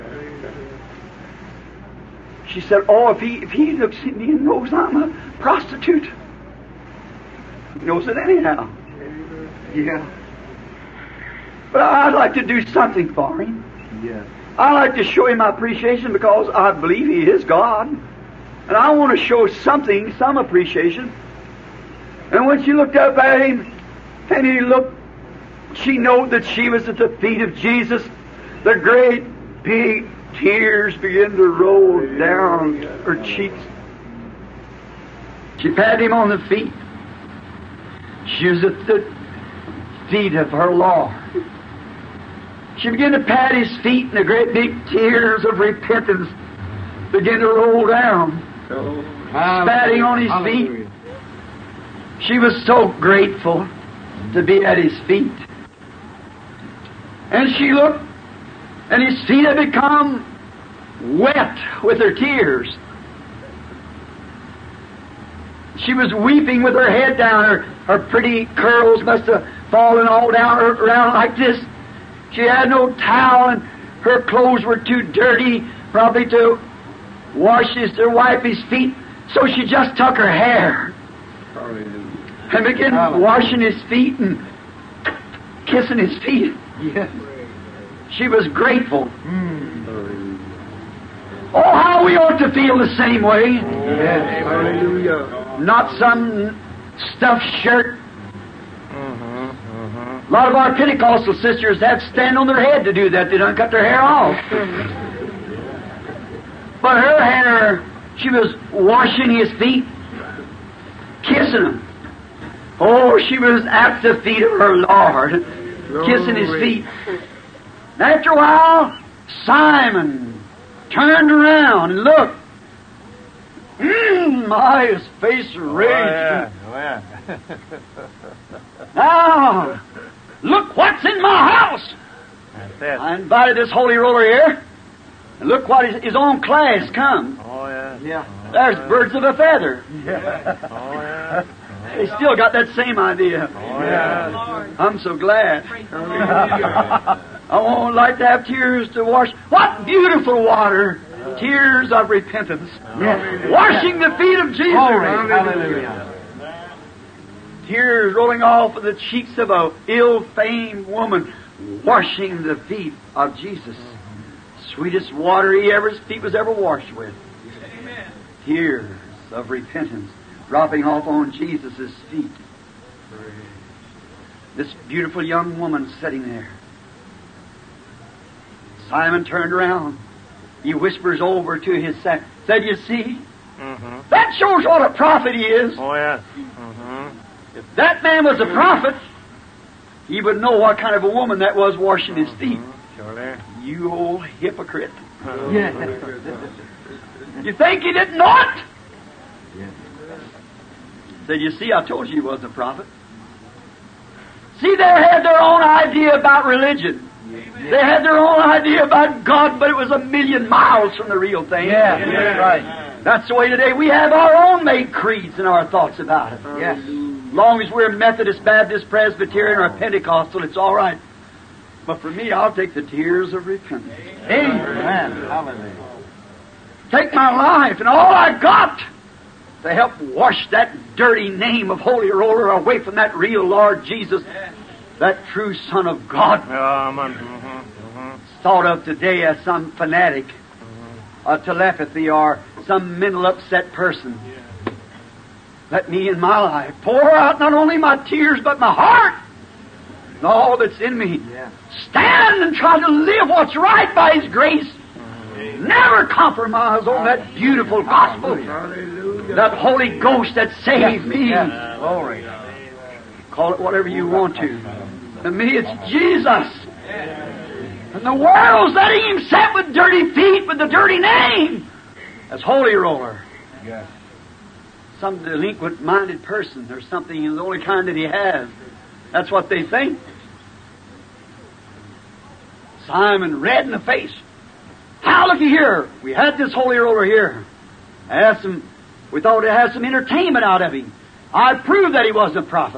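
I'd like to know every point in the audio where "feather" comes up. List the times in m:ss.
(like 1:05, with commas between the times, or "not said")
2:19.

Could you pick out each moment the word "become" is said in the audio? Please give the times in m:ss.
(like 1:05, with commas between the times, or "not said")
0:59.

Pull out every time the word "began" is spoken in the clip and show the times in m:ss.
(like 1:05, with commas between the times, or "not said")
0:30, 0:42, 0:47, 1:22.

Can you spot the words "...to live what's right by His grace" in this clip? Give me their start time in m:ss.
4:12.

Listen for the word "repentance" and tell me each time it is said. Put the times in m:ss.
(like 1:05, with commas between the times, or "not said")
0:45, 2:32, 2:49, 3:43.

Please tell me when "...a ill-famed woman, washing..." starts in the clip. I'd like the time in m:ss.
2:39.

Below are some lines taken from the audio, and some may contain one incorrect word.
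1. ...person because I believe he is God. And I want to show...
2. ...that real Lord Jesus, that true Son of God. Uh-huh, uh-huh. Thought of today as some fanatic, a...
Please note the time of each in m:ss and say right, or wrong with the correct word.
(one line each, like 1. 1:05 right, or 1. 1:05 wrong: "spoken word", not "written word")
1. 0:15 wrong: "appreciation", not "person"
2. 3:52 right.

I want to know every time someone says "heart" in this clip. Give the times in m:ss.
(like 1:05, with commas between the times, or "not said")
4:08.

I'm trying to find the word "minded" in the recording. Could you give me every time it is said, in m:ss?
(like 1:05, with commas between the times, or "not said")
4:35.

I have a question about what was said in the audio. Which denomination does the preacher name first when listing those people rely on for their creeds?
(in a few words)
Methodist.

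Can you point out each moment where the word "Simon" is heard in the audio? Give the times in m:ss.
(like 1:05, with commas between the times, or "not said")
1:59, 2:58, 4:42.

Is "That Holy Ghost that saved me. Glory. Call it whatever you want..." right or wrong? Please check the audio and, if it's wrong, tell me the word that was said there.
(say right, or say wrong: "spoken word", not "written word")
right.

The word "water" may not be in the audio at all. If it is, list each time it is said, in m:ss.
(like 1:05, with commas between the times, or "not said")
2:30, 2:45.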